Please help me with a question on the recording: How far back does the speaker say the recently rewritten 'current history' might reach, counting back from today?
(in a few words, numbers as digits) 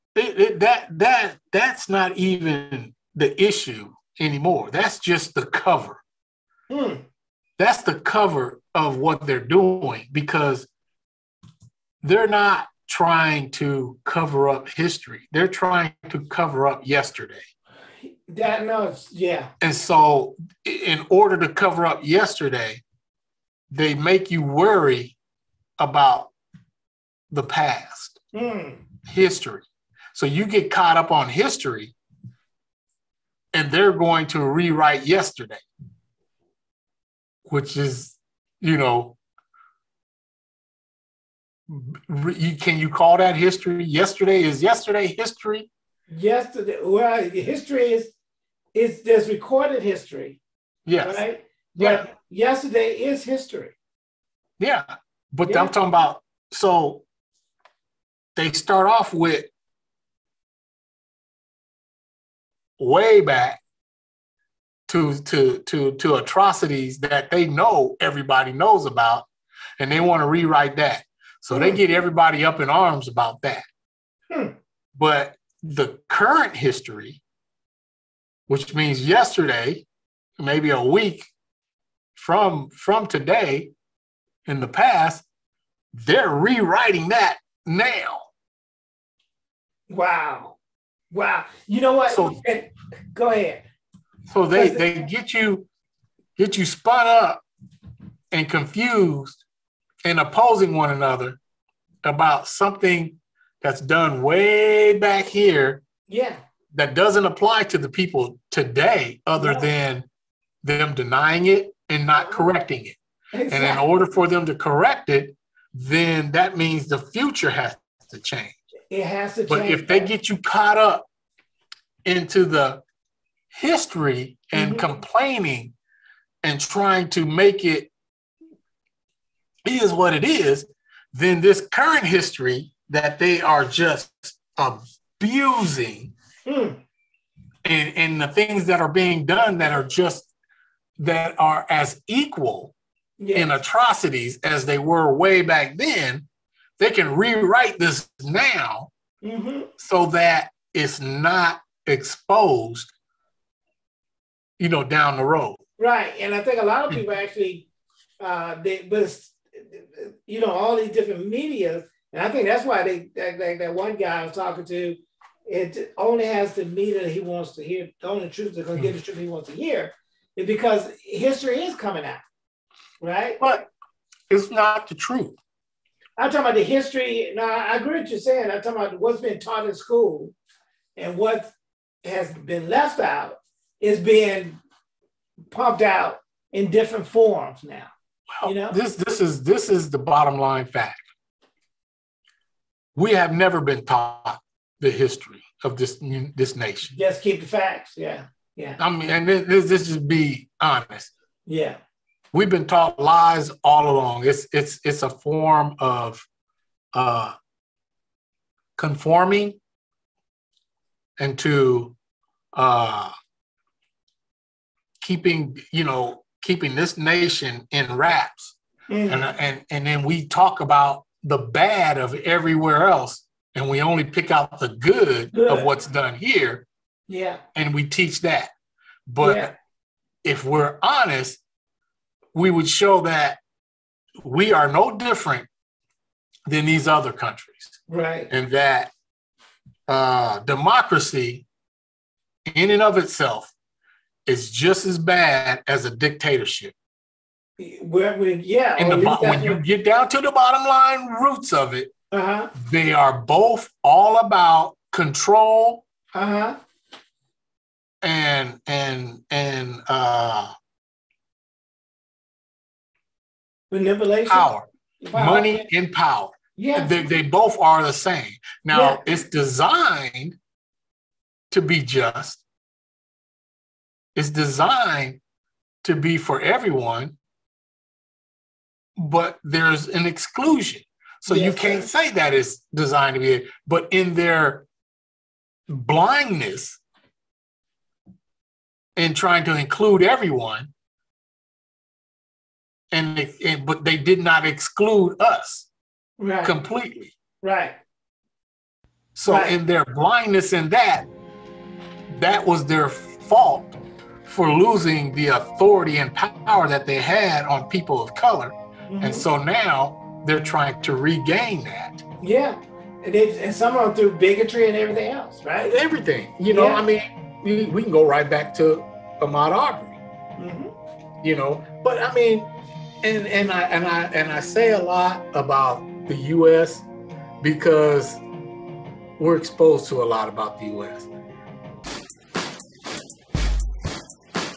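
A week.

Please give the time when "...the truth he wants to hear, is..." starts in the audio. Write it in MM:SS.
02:48.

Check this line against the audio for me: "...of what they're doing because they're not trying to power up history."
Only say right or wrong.
wrong.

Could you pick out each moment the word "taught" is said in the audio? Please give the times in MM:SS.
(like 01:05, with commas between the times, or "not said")
02:59, 03:13, 03:22.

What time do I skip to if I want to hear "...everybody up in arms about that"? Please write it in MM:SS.
01:11.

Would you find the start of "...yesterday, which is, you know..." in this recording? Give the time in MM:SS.
00:35.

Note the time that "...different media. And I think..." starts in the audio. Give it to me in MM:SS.
02:40.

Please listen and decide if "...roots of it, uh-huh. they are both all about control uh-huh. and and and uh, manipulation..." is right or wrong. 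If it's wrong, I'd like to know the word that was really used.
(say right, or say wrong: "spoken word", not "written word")
right.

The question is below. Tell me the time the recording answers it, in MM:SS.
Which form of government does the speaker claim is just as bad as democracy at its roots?
04:05.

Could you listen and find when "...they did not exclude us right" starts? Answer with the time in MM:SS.
04:53.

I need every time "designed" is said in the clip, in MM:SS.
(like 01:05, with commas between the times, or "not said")
04:29, 04:34, 04:42.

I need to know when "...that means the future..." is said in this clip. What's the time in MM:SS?
01:56.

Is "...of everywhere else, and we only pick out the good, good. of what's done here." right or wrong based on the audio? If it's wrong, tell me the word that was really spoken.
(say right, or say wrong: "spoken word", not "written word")
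right.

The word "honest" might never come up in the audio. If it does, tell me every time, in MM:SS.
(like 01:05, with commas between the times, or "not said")
03:20, 03:50.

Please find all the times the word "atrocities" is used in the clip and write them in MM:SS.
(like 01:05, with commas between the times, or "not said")
01:06, 02:23.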